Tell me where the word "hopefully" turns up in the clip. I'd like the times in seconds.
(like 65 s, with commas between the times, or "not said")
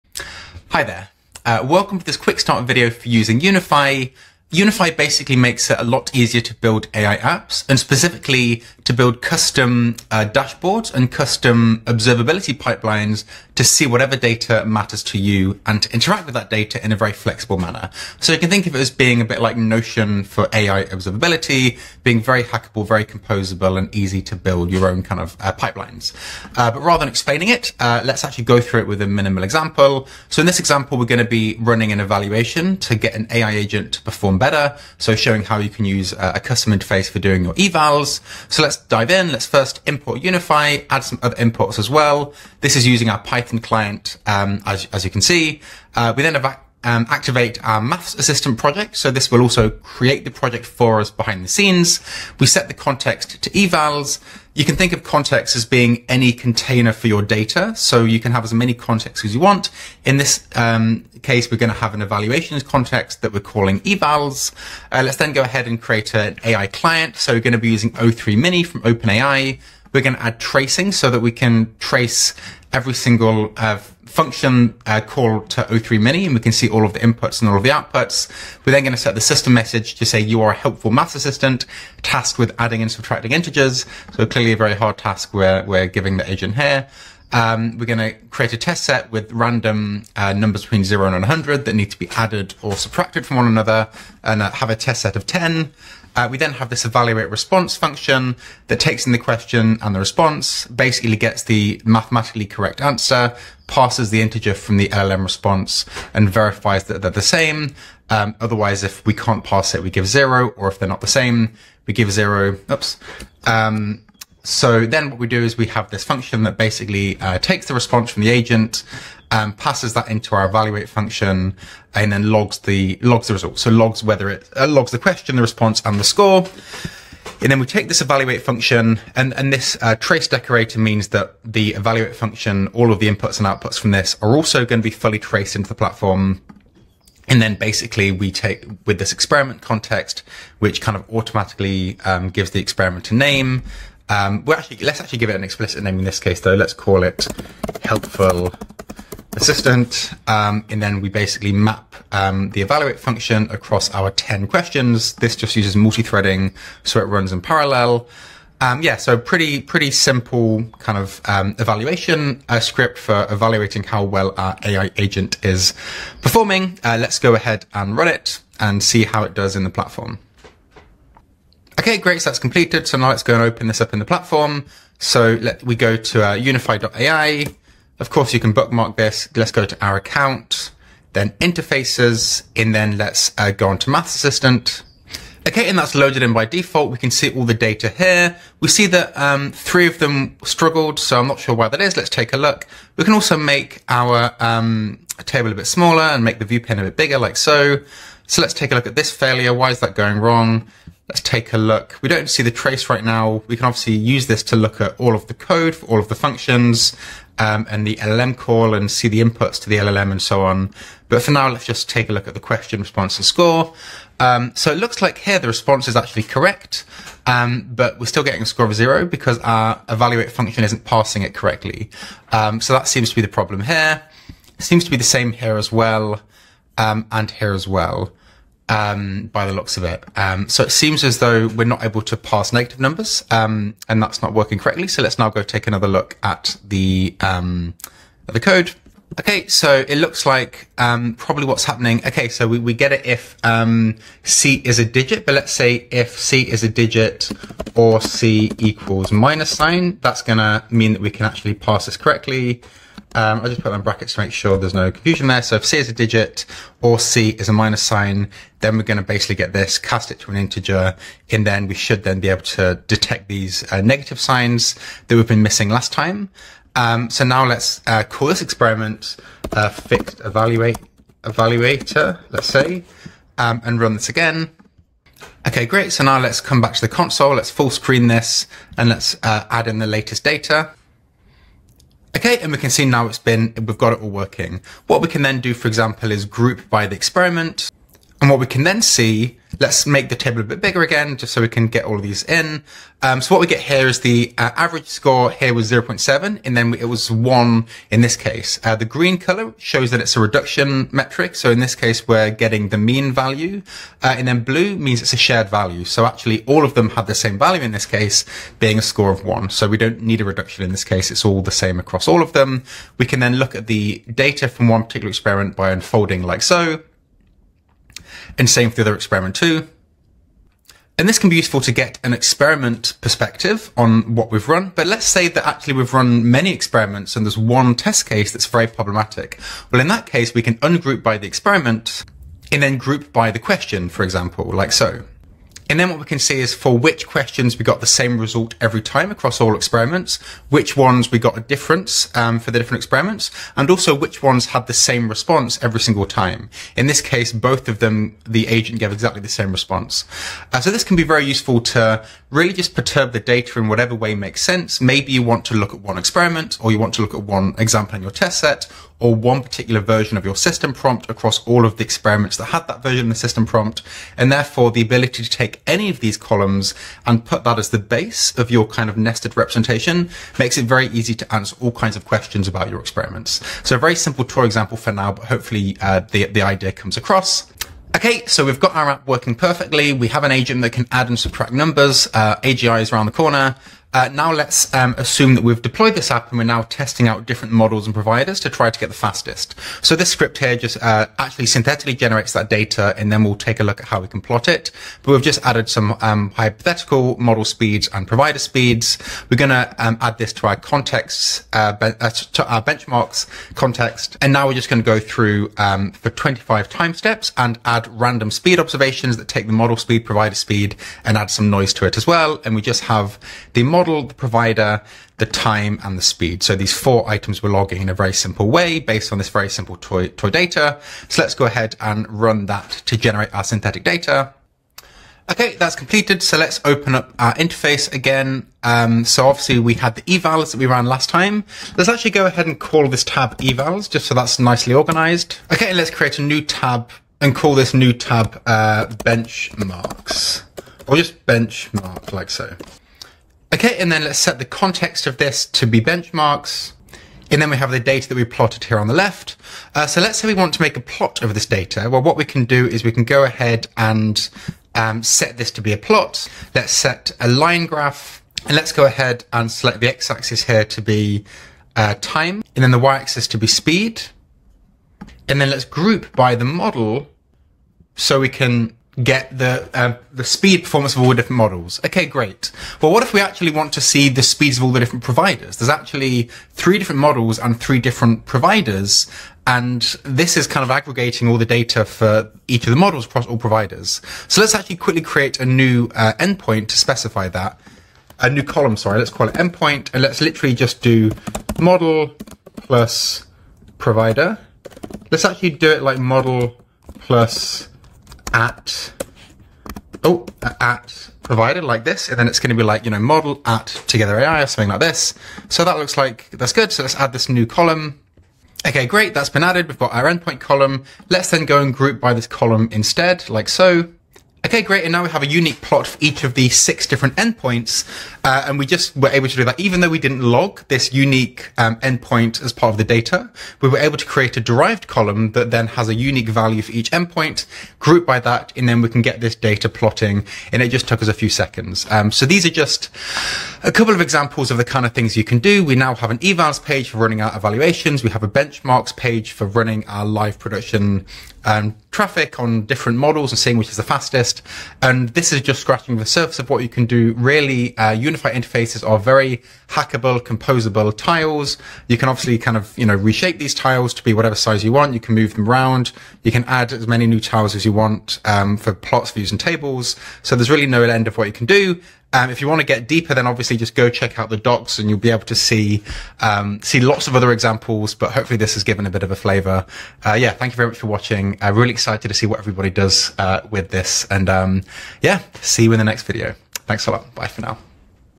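375 s, 568 s.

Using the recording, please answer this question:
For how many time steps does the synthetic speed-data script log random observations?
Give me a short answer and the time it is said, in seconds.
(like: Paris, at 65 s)
25, at 406 s.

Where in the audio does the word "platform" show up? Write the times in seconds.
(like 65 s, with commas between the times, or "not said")
135 s, 169 s, 174 s.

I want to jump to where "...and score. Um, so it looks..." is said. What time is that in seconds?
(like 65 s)
213 s.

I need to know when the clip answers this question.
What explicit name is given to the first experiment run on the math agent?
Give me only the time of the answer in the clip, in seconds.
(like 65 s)
147 s.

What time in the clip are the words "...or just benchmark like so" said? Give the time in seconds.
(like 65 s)
440 s.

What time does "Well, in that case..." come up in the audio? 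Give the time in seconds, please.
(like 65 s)
329 s.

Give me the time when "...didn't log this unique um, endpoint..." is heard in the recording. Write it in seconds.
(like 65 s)
519 s.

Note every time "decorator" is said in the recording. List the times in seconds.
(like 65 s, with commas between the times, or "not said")
130 s.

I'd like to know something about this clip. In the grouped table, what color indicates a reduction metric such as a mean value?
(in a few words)
green.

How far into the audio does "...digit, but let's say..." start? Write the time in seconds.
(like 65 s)
244 s.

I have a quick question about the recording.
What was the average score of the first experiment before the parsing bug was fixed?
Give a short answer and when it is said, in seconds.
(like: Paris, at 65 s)
0.7, at 295 s.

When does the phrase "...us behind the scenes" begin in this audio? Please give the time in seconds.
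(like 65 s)
50 s.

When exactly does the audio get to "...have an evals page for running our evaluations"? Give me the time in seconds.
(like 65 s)
535 s.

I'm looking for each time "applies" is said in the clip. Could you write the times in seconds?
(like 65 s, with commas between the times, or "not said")
not said.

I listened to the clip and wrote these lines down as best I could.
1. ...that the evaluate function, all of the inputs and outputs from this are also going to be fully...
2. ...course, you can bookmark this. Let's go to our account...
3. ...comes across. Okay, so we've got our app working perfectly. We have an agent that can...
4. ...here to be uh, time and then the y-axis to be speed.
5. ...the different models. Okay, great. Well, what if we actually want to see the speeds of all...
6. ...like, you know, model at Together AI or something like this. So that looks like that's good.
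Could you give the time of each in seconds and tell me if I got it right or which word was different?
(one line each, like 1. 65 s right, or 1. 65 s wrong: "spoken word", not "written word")
1. 131 s right
2. 178 s right
3. 376 s right
4. 460 s right
5. 471 s right
6. 502 s right.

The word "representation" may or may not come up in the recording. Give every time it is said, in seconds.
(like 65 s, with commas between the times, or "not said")
369 s.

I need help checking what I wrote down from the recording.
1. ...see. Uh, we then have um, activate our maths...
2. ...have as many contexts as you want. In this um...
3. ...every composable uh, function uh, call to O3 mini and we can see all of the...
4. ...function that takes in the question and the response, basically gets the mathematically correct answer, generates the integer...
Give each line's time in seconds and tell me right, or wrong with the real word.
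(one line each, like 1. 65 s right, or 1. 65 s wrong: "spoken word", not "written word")
1. 45 s right
2. 58 s right
3. 72 s wrong: "single", not "composable"
4. 97 s wrong: "passes", not "generates".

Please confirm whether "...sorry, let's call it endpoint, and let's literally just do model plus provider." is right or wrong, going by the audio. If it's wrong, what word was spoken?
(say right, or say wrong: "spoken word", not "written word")
right.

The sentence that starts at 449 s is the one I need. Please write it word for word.
Uh, so let's say we want to make a plot of this data.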